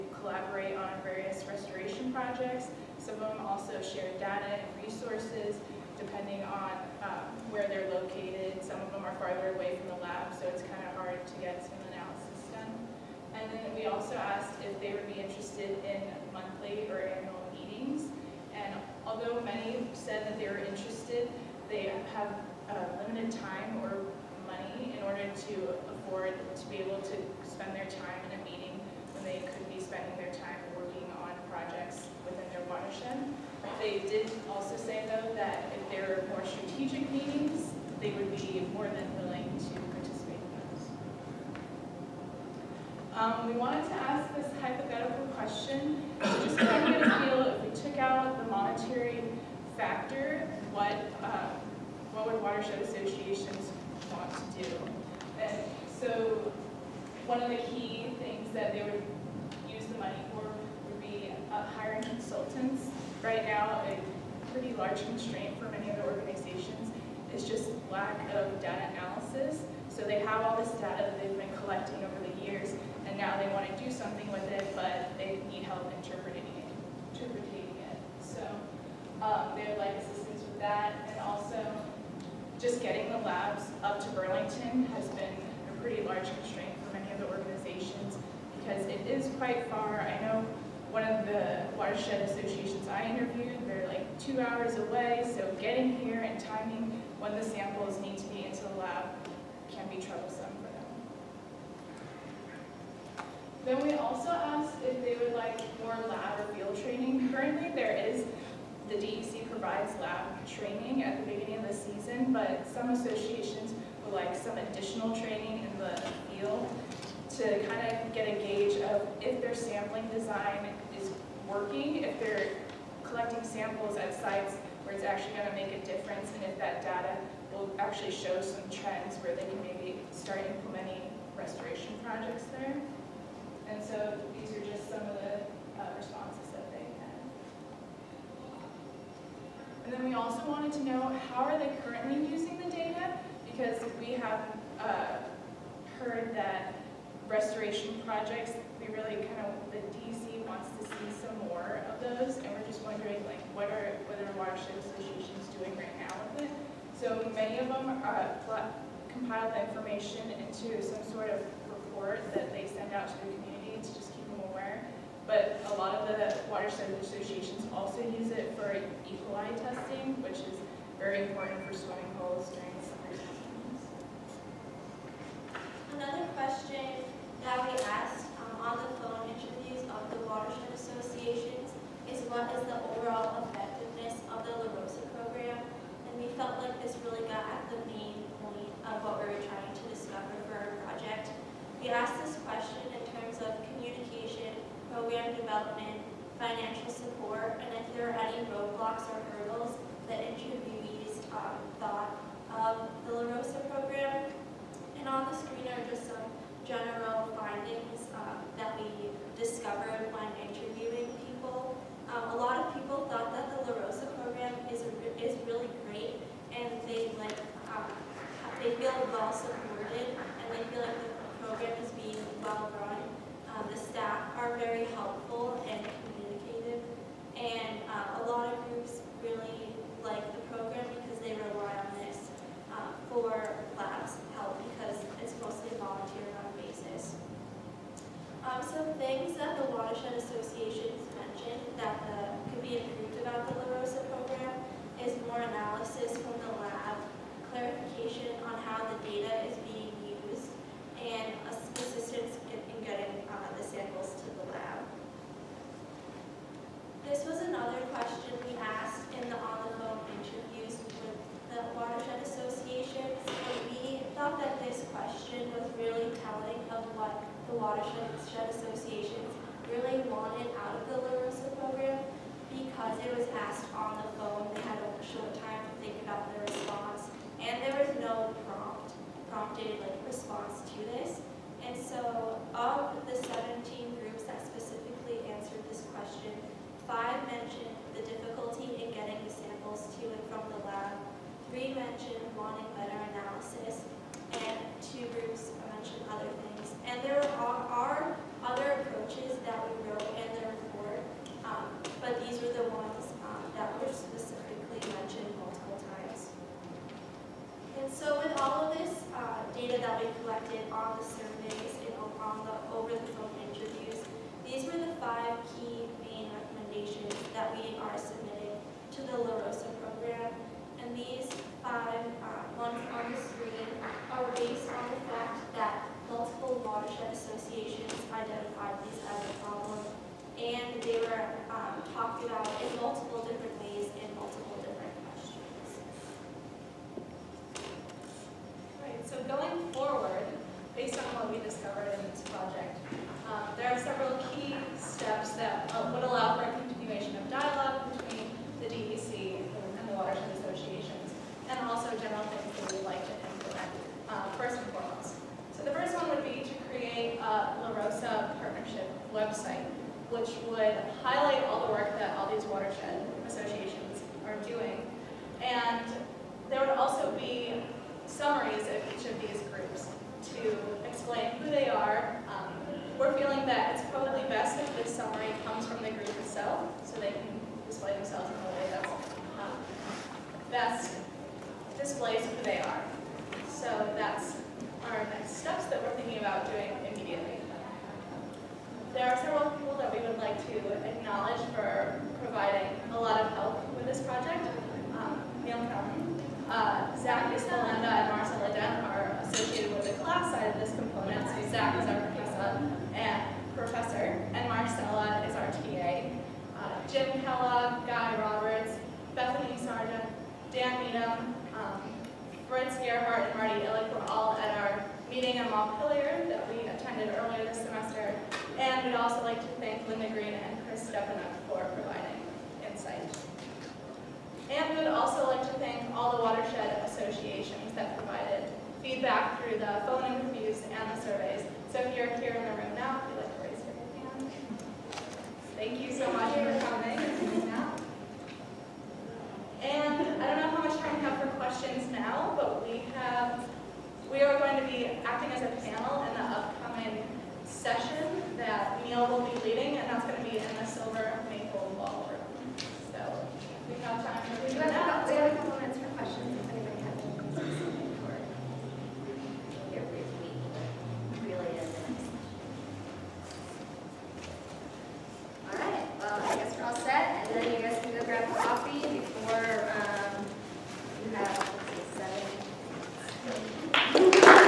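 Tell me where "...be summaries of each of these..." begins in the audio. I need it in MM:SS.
06:07.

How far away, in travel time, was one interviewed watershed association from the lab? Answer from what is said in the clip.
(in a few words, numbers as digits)
2 hours.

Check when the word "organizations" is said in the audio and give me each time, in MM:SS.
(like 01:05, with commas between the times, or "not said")
01:06, 01:27.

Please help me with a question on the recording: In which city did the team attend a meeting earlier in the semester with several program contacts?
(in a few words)
Montpelier.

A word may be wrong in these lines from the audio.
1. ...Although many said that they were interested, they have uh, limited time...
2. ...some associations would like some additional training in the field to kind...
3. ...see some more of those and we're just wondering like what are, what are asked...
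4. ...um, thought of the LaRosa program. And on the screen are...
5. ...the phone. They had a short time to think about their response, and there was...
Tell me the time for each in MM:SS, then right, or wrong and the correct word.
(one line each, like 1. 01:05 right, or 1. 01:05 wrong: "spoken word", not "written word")
1. 00:19 right
2. 01:52 right
3. 02:30 wrong: "watershed", not "asked"
4. 03:21 right
5. 04:34 right.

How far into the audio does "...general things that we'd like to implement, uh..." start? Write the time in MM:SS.
05:52.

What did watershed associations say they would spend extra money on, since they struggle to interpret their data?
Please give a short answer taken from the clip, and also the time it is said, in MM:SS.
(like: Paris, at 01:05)
Hiring consultants, at 01:01.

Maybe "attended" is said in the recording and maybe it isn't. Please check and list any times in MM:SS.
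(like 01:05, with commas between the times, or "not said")
06:56.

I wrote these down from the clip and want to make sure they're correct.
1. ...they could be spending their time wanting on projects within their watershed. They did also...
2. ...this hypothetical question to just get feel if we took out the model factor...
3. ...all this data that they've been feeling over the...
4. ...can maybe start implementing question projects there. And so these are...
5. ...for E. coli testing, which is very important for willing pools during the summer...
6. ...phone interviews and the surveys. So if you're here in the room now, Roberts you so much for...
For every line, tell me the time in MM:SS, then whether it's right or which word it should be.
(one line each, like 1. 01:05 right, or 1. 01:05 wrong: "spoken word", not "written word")
1. 00:29 wrong: "working", not "wanting"
2. 00:44 right
3. 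01:10 wrong: "collecting", not "feeling"
4. 02:09 wrong: "restoration", not "question"
5. 02:48 wrong: "swimming", not "willing"
6. 07:09 wrong: "Thank", not "Roberts".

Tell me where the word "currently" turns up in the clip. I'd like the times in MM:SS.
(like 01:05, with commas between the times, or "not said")
01:47, 02:21.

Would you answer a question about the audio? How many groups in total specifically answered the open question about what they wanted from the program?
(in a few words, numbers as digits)
17.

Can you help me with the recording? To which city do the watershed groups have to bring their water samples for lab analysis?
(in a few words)
Burlington.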